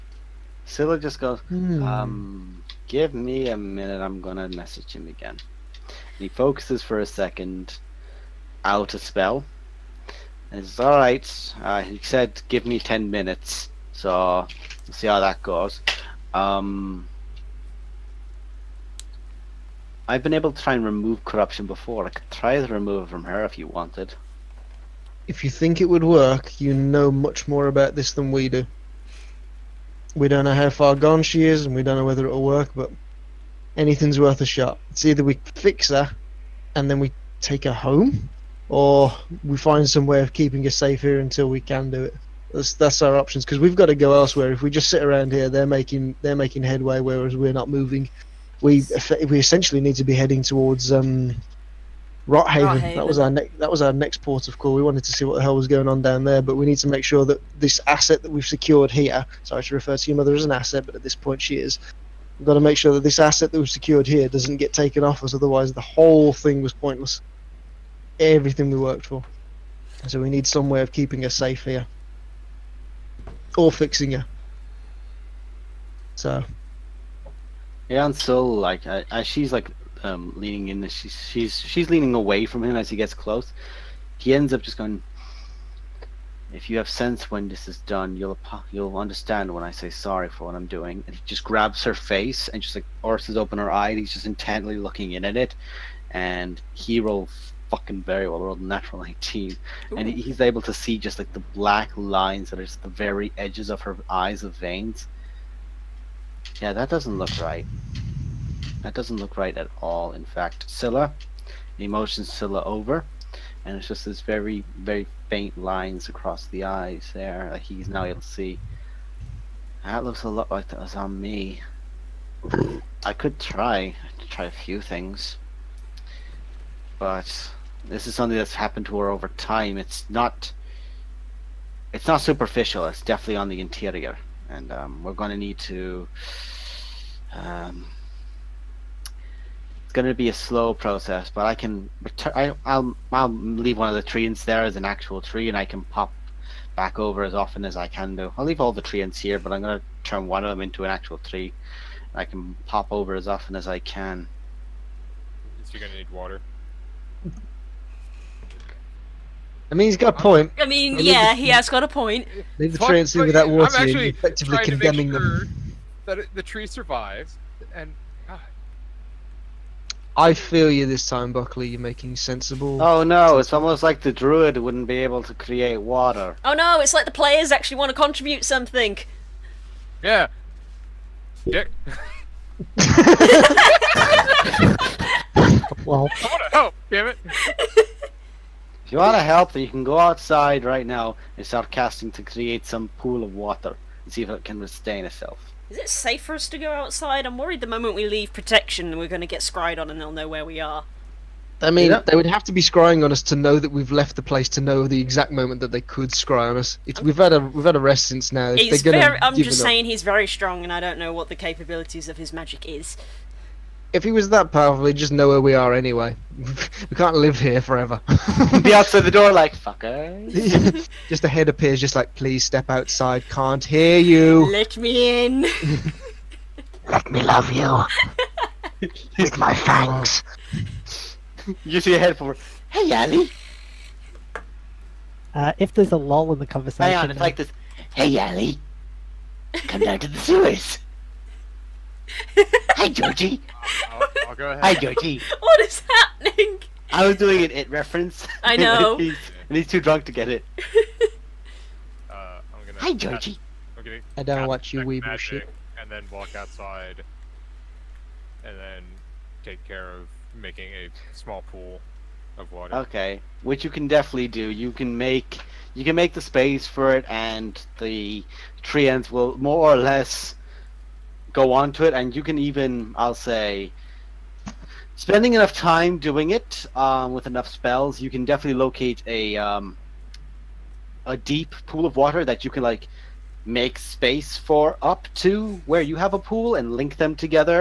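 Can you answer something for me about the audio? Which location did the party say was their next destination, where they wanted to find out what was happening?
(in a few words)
Rothaven.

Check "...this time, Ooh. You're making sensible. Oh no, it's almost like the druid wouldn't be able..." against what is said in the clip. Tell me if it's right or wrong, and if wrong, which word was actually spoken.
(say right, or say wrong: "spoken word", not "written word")
wrong: "Buckley", not "Ooh".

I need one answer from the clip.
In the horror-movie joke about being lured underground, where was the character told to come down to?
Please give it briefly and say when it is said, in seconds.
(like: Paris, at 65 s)
The sewers, at 240 s.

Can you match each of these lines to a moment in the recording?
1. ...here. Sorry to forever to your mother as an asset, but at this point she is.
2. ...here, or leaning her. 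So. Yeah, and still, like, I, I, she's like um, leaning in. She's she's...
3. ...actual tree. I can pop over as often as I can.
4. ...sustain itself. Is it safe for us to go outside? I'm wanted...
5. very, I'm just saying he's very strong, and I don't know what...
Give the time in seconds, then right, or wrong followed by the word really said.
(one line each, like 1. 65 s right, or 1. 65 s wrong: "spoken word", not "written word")
1. 58 s wrong: "refer", not "forever"
2. 71 s wrong: "fixing", not "leaning"
3. 150 s right
4. 194 s wrong: "worried", not "wanted"
5. 208 s right.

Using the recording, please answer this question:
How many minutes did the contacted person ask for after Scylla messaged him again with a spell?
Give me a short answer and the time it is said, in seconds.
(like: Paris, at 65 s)
10, at 12 s.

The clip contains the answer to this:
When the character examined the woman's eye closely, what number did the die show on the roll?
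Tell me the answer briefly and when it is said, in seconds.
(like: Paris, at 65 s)
19, at 99 s.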